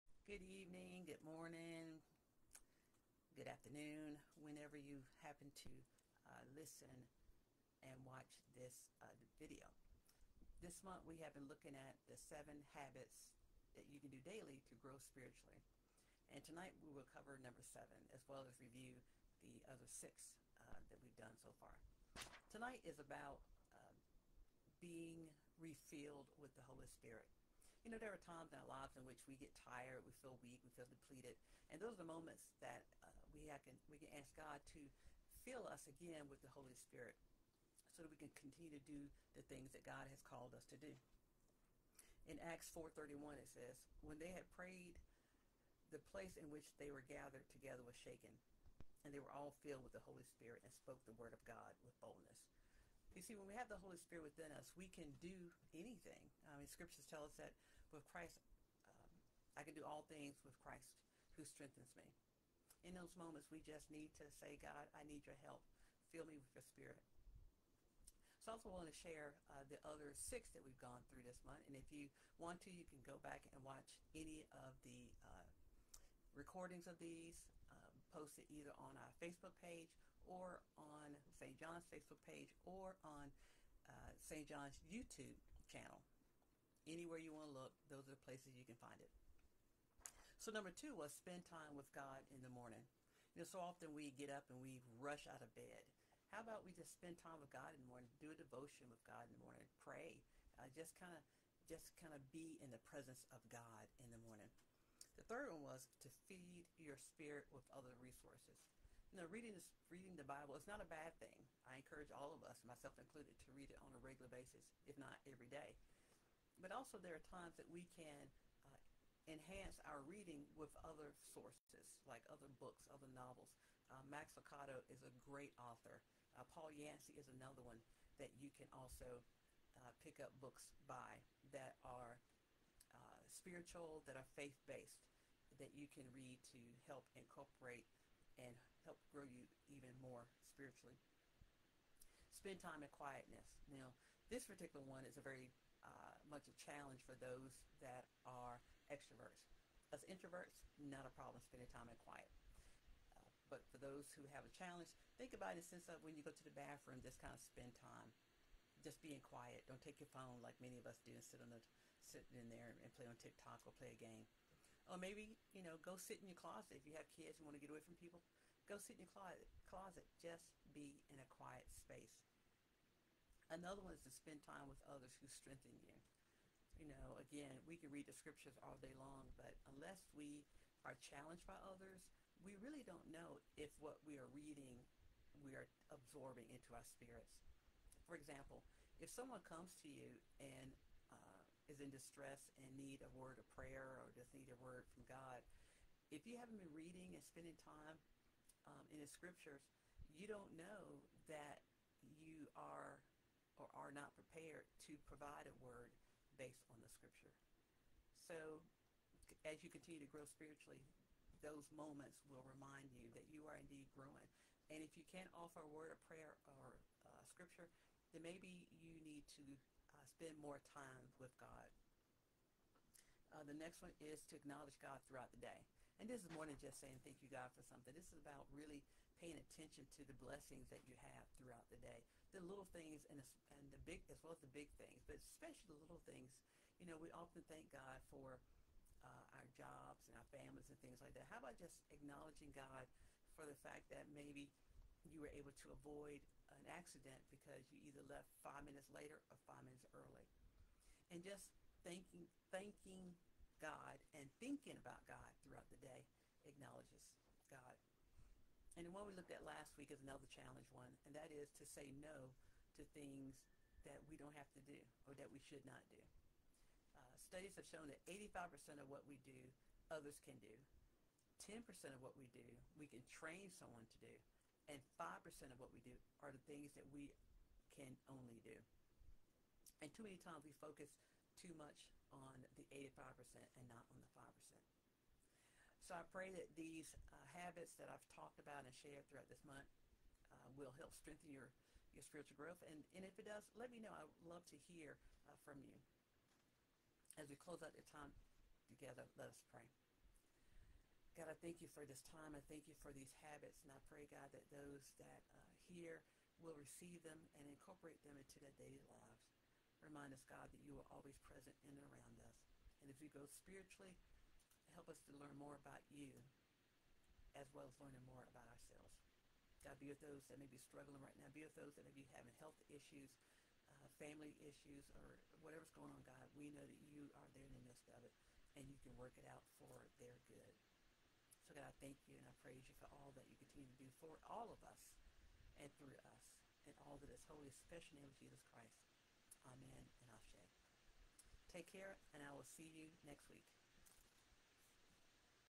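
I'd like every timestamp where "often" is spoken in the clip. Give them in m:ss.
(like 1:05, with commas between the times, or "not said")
1:33, 3:57.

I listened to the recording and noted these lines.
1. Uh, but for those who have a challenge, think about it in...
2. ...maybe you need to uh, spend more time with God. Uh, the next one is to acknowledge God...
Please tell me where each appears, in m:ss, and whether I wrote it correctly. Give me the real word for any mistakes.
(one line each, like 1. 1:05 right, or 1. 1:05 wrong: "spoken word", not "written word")
1. 2:33 right
2. 3:38 right.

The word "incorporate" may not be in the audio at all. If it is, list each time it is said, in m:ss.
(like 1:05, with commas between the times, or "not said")
2:17, 5:07.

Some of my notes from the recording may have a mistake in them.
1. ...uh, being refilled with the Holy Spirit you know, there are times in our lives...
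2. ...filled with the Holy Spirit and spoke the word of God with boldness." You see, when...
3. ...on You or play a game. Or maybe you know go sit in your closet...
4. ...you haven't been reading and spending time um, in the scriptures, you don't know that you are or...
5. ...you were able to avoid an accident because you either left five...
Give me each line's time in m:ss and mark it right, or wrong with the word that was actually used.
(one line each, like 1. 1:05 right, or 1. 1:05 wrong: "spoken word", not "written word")
1. 0:23 right
2. 0:49 right
3. 2:43 wrong: "TikTok", not "You"
4. 3:16 right
5. 4:05 right.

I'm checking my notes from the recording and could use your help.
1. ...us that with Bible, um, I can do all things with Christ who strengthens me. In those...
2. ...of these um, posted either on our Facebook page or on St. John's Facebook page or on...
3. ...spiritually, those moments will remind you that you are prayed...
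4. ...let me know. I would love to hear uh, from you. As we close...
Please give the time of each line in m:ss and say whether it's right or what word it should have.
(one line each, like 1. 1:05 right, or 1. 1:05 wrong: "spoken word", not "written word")
1. 0:57 wrong: "Christ", not "Bible"
2. 1:16 right
3. 3:30 wrong: "indeed", not "prayed"
4. 4:53 right.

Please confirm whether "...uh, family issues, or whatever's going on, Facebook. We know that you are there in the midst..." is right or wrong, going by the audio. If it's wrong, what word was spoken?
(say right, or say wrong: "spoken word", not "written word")
wrong: "God", not "Facebook".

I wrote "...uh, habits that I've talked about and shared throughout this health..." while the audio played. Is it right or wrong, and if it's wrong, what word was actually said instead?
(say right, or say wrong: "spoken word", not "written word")
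wrong: "month", not "health".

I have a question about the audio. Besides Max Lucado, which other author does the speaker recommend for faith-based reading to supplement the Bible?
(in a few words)
Paul Yancey.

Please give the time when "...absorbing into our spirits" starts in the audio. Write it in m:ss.
3:05.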